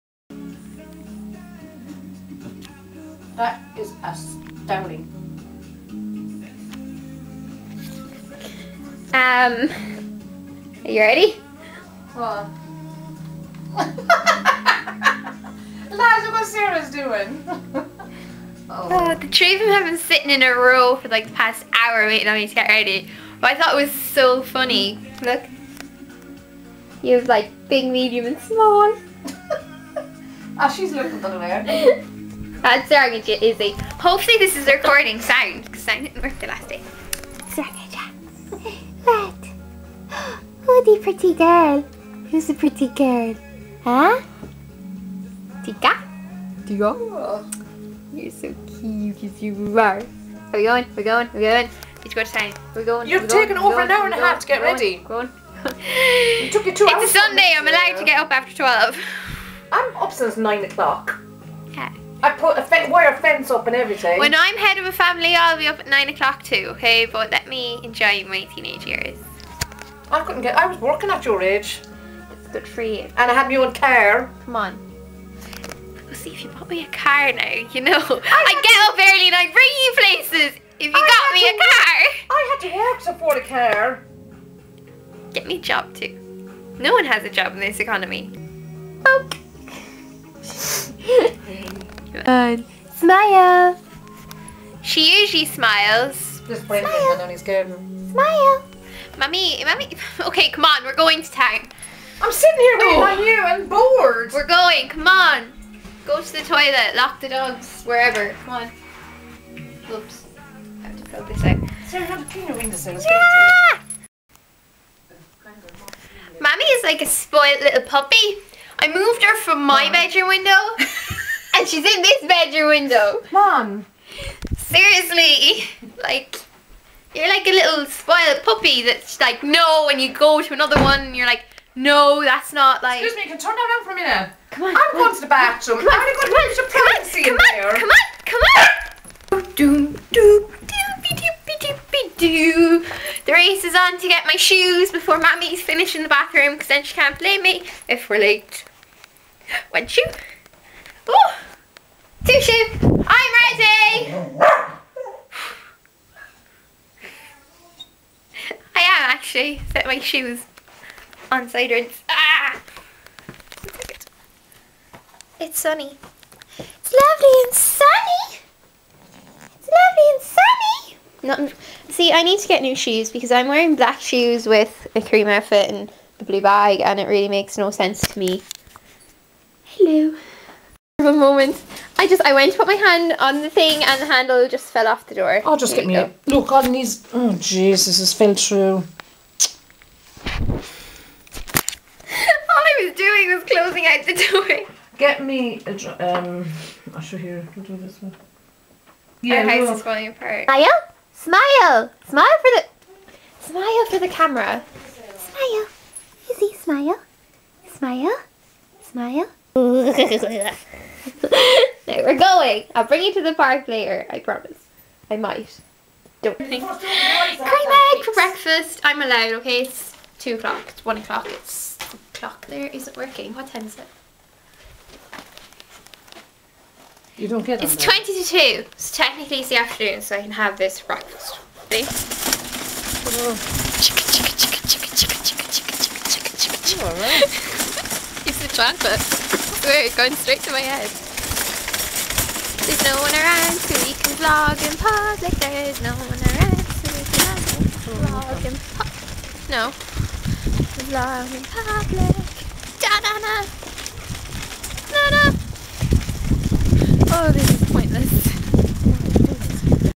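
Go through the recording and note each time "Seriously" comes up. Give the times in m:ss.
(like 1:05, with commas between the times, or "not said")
2:04.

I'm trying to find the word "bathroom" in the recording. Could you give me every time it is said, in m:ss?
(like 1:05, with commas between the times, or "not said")
2:15, 2:26.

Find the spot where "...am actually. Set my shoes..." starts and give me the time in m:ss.
2:38.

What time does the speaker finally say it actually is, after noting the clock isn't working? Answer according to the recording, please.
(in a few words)
twenty to two.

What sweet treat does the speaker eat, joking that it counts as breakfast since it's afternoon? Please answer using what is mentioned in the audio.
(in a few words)
Cream egg.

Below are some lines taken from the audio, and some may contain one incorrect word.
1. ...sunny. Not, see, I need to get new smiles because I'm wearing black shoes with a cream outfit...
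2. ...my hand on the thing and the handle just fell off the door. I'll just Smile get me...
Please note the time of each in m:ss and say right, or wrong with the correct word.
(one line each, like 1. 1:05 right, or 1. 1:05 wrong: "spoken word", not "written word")
1. 2:50 wrong: "shoes", not "smiles"
2. 3:02 wrong: "Here", not "Smile".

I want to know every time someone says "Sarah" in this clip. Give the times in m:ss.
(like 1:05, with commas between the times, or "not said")
0:16, 1:51.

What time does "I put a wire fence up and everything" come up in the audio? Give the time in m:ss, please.
1:02.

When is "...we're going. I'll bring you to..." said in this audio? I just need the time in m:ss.
3:31.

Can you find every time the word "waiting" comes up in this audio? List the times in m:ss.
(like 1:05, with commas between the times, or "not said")
0:22, 1:42.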